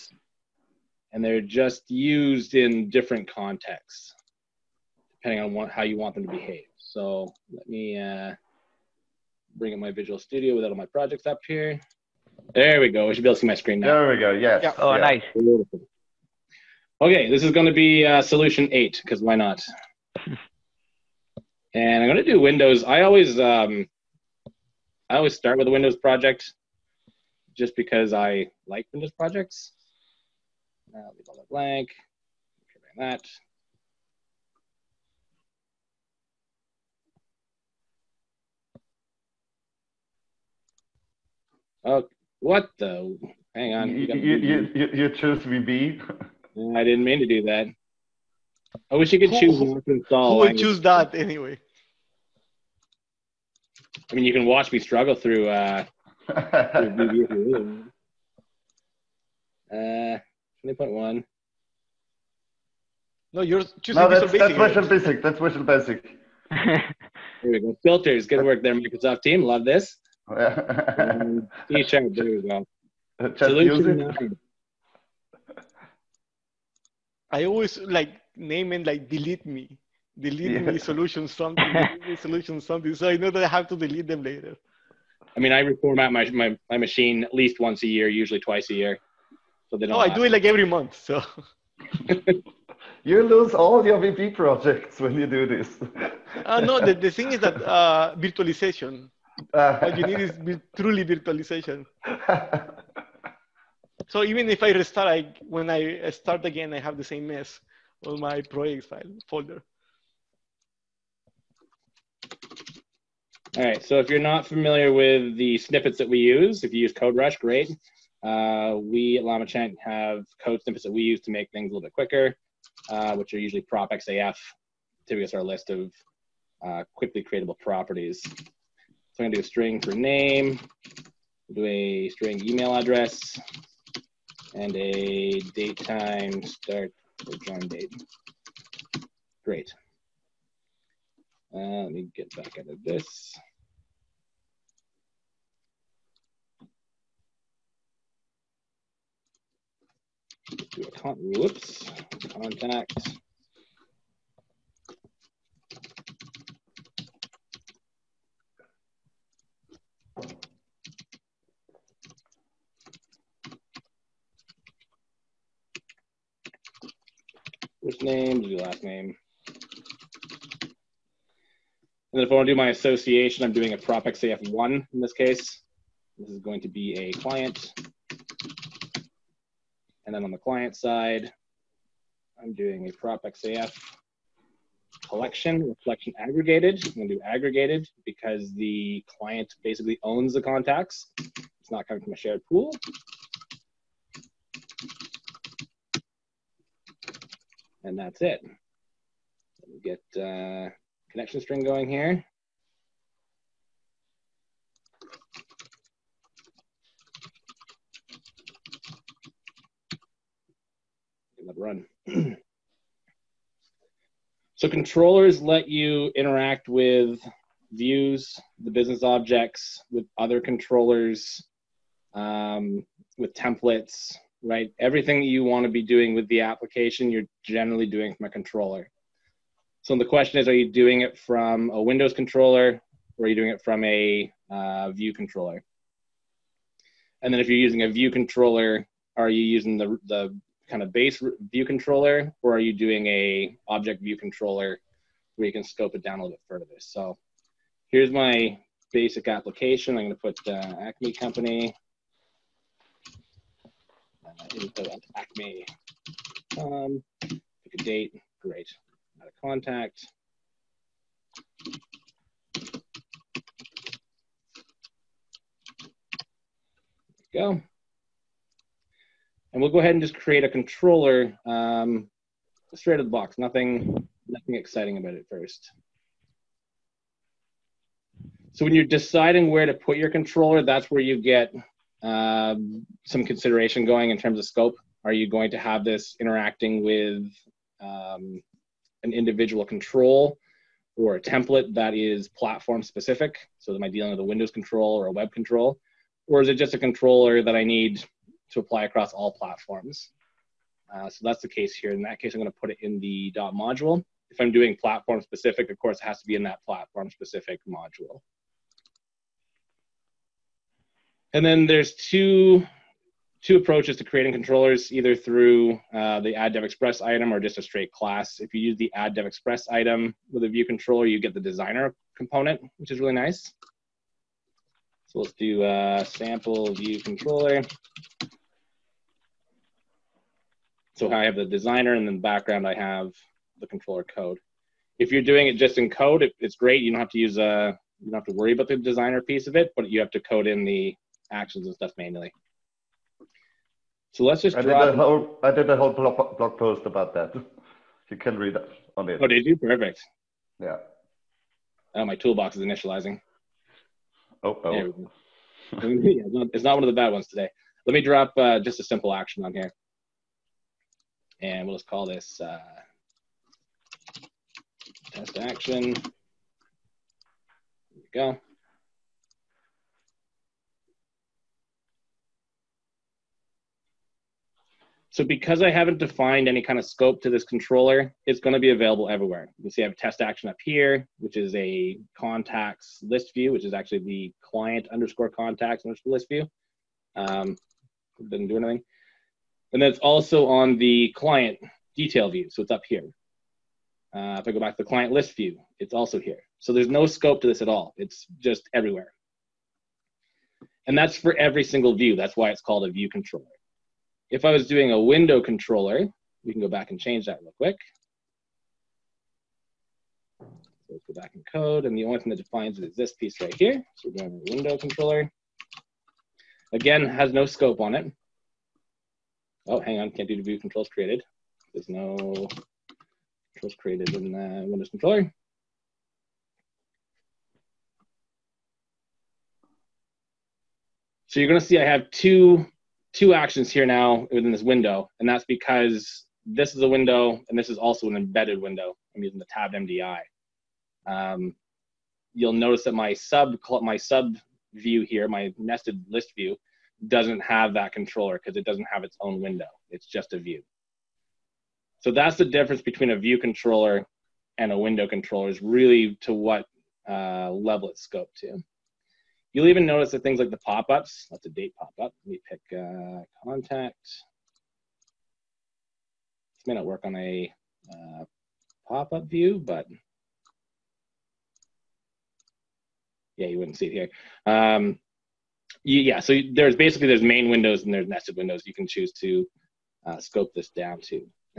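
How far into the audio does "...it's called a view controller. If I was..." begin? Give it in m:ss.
6:42.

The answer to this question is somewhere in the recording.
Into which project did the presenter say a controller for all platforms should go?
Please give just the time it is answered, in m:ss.
5:03.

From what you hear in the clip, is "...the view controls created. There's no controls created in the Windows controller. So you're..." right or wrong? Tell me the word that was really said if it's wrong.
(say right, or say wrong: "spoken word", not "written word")
right.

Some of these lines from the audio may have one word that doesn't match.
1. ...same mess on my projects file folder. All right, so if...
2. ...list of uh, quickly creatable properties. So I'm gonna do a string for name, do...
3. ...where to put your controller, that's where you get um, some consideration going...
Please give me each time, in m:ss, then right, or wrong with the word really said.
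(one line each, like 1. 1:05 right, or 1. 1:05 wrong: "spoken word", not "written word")
1. 1:47 right
2. 2:05 right
3. 4:39 right.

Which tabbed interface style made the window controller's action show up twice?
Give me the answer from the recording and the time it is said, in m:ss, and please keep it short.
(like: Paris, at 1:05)
tab MDI, at 7:19.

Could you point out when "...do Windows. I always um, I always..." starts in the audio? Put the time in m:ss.
0:22.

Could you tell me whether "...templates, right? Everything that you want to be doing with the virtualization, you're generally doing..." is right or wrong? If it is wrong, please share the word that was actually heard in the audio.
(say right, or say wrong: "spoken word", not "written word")
wrong: "application", not "virtualization".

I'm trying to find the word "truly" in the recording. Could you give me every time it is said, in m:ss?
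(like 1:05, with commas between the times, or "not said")
1:40.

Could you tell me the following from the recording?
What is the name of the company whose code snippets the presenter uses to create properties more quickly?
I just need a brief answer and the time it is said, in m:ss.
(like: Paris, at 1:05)
LlamaChant, at 1:59.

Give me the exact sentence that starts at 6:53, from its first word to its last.
So we're doing a window controller.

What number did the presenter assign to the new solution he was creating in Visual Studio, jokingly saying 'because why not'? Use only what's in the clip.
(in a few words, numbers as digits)
8.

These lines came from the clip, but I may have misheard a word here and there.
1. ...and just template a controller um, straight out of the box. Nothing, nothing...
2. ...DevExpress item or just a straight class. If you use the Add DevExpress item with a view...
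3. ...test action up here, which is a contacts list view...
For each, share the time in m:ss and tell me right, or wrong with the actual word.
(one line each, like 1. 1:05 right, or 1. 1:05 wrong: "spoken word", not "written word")
1. 4:29 wrong: "create", not "template"
2. 5:16 right
3. 6:19 right.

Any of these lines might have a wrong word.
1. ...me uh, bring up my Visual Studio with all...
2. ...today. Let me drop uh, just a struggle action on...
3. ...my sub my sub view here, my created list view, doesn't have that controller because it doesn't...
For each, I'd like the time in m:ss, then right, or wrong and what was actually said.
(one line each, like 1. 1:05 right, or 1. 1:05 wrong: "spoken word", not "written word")
1. 0:07 right
2. 5:57 wrong: "simple", not "struggle"
3. 7:22 wrong: "nested", not "created".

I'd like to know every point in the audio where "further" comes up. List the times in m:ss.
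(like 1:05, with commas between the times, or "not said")
4:06.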